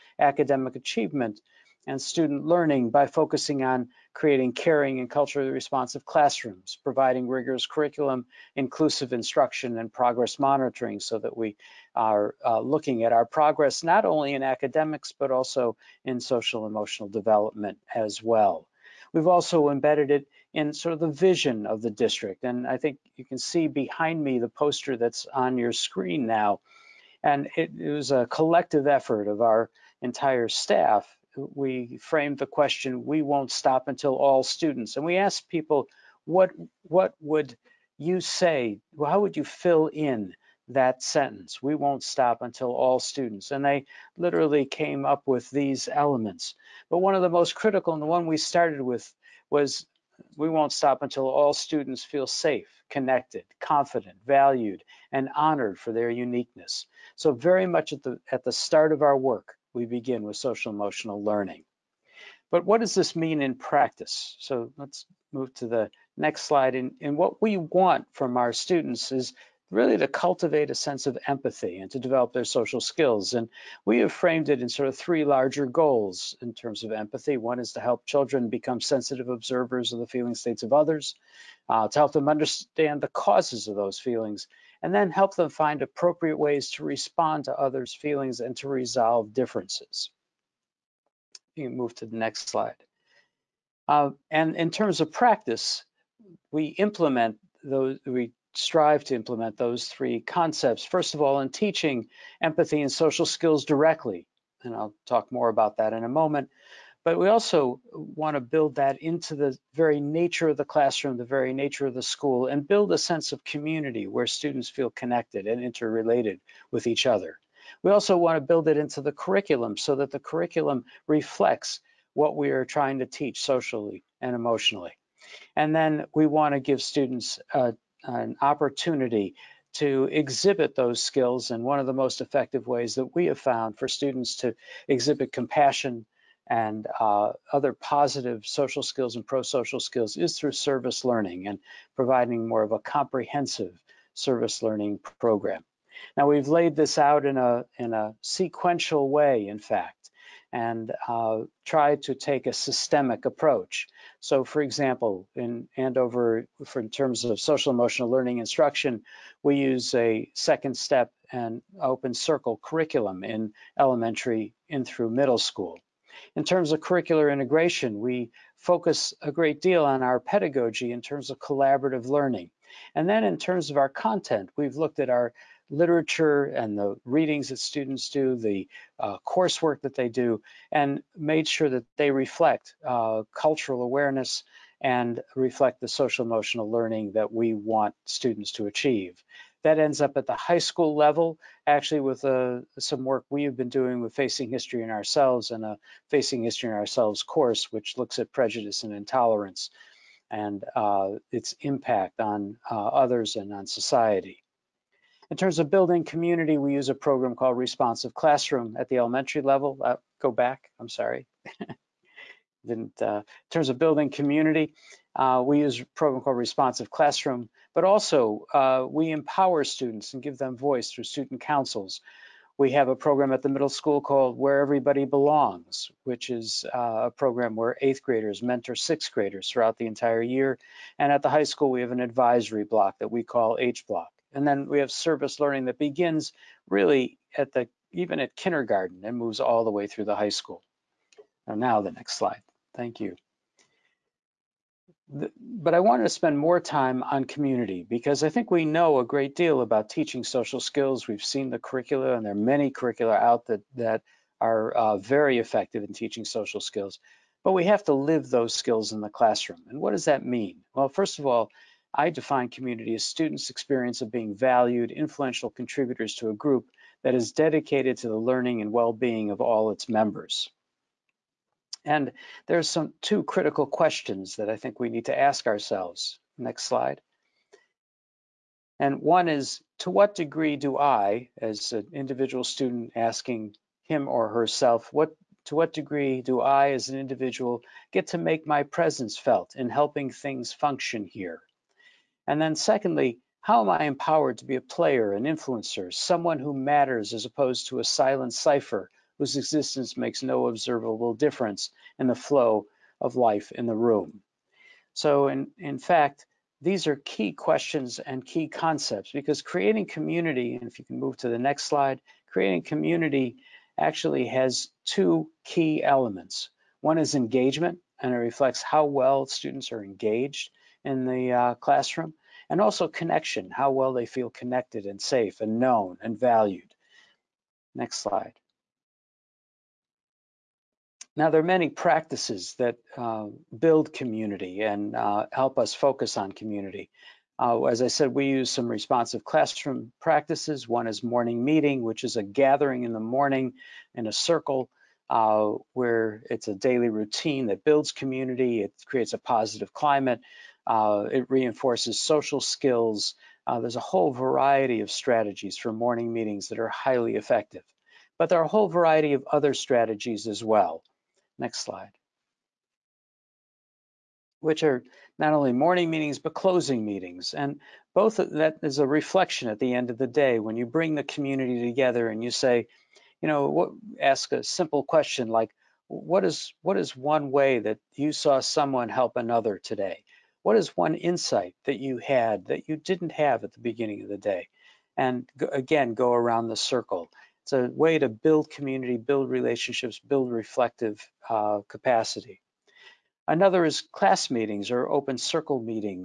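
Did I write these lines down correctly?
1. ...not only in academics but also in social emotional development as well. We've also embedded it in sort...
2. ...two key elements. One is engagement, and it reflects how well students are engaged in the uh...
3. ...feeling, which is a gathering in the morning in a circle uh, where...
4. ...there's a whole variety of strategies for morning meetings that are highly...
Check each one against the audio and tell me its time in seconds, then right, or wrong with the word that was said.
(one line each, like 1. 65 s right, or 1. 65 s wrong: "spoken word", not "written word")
1. 13 s right
2. 314 s right
3. 341 s wrong: "meeting", not "feeling"
4. 353 s right.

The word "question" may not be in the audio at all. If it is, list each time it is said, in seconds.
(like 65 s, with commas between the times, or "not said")
32 s, 273 s, 307 s, 374 s.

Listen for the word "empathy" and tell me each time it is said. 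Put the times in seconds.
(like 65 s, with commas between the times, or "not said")
71 s, 76 s, 102 s.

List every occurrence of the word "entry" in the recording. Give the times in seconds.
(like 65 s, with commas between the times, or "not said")
not said.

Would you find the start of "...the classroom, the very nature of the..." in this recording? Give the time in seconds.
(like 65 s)
110 s.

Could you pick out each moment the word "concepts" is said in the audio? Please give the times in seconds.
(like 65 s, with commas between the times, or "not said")
100 s, 308 s.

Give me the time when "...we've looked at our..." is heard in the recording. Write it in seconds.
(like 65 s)
174 s.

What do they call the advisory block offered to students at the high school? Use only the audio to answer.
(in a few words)
H block.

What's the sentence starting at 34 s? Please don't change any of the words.
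And we asked people, what, what would you say, how would you fill in that sentence?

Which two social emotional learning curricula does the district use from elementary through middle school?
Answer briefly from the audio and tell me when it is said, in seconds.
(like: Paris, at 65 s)
Second Step and Open Circle, at 160 s.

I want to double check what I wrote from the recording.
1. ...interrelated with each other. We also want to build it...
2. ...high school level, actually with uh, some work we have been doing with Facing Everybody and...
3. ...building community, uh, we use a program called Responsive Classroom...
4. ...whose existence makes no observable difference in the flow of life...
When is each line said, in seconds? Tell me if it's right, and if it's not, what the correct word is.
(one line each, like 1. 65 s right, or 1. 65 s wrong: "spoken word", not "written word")
1. 115 s right
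2. 190 s wrong: "History", not "Everybody"
3. 213 s right
4. 299 s right.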